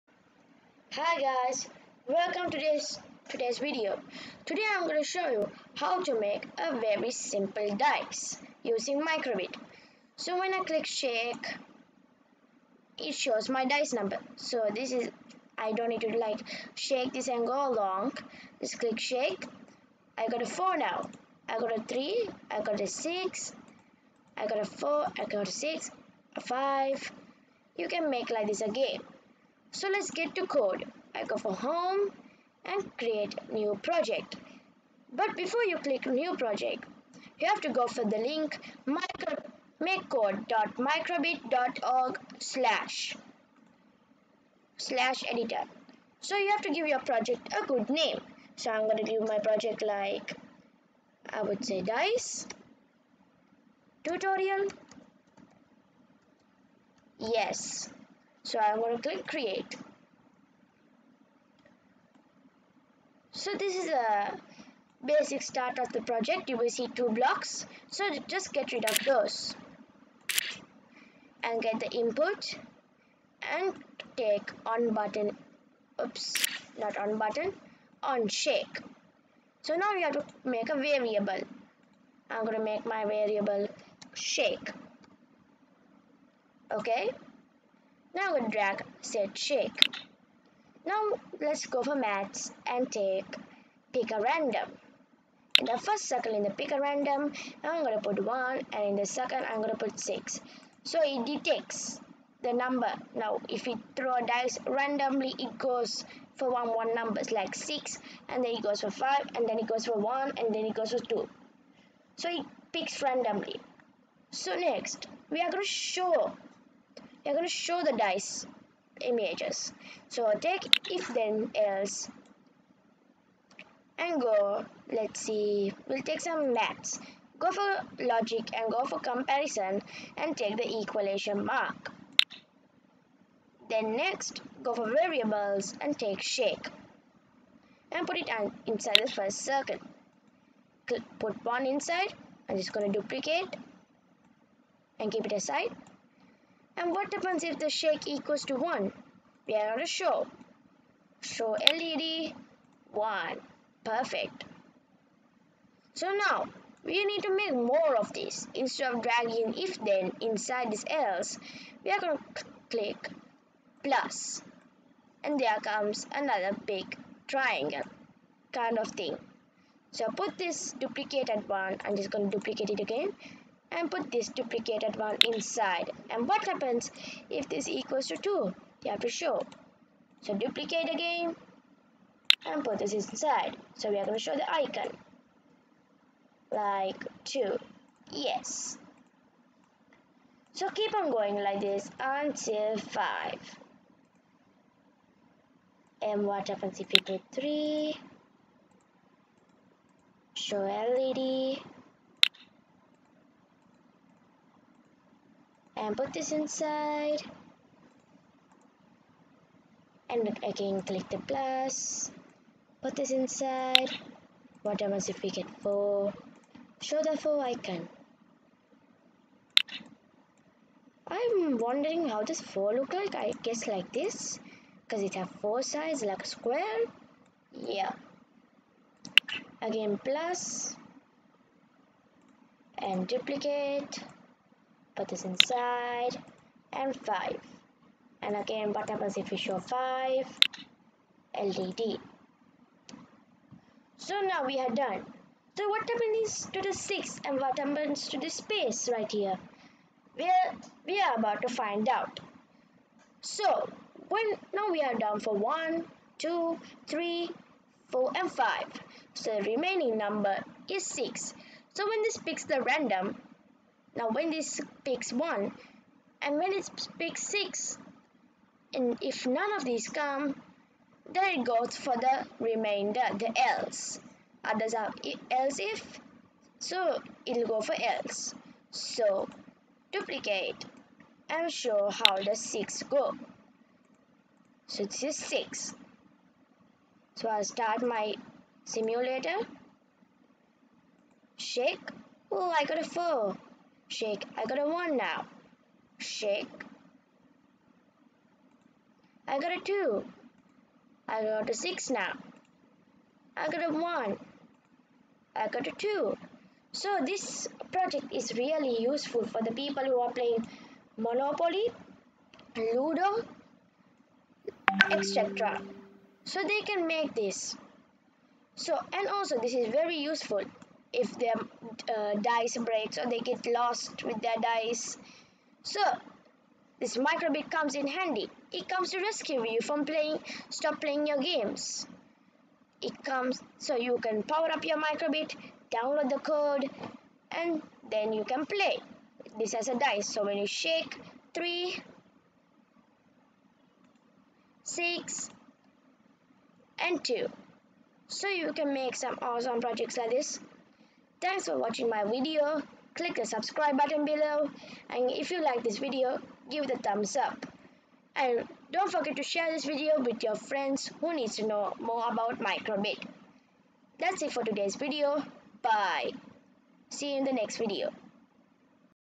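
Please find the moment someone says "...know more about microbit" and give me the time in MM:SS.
06:01.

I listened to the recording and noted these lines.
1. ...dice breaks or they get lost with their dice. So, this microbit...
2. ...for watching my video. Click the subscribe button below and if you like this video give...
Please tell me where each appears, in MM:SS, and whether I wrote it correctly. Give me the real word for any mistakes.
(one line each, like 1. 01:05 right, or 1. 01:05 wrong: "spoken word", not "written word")
1. 05:22 right
2. 05:51 right.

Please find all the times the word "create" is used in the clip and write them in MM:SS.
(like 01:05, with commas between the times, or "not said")
00:32, 00:59.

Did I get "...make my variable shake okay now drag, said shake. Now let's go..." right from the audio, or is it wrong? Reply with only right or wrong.
right.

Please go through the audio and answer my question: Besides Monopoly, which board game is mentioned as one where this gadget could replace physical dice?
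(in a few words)
Ludo.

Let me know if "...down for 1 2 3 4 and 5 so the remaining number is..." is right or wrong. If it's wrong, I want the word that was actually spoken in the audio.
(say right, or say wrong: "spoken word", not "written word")
right.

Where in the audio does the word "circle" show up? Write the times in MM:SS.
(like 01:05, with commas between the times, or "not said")
01:36, 02:19.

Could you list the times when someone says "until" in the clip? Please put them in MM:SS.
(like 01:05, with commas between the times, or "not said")
03:11.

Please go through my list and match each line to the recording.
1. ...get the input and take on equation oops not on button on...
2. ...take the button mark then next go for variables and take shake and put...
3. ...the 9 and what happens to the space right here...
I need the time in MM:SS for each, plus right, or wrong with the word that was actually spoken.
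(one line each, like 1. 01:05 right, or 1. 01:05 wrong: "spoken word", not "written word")
1. 01:11 wrong: "button", not "equation"
2. 02:10 wrong: "equation", not "button"
3. 04:06 wrong: "6", not "9".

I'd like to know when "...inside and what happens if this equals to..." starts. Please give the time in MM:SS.
02:55.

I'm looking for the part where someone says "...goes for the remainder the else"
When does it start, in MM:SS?
04:31.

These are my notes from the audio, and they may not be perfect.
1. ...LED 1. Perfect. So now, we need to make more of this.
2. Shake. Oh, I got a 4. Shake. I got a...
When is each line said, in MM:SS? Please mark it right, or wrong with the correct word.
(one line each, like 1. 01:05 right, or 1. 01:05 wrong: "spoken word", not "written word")
1. 02:31 right
2. 04:51 right.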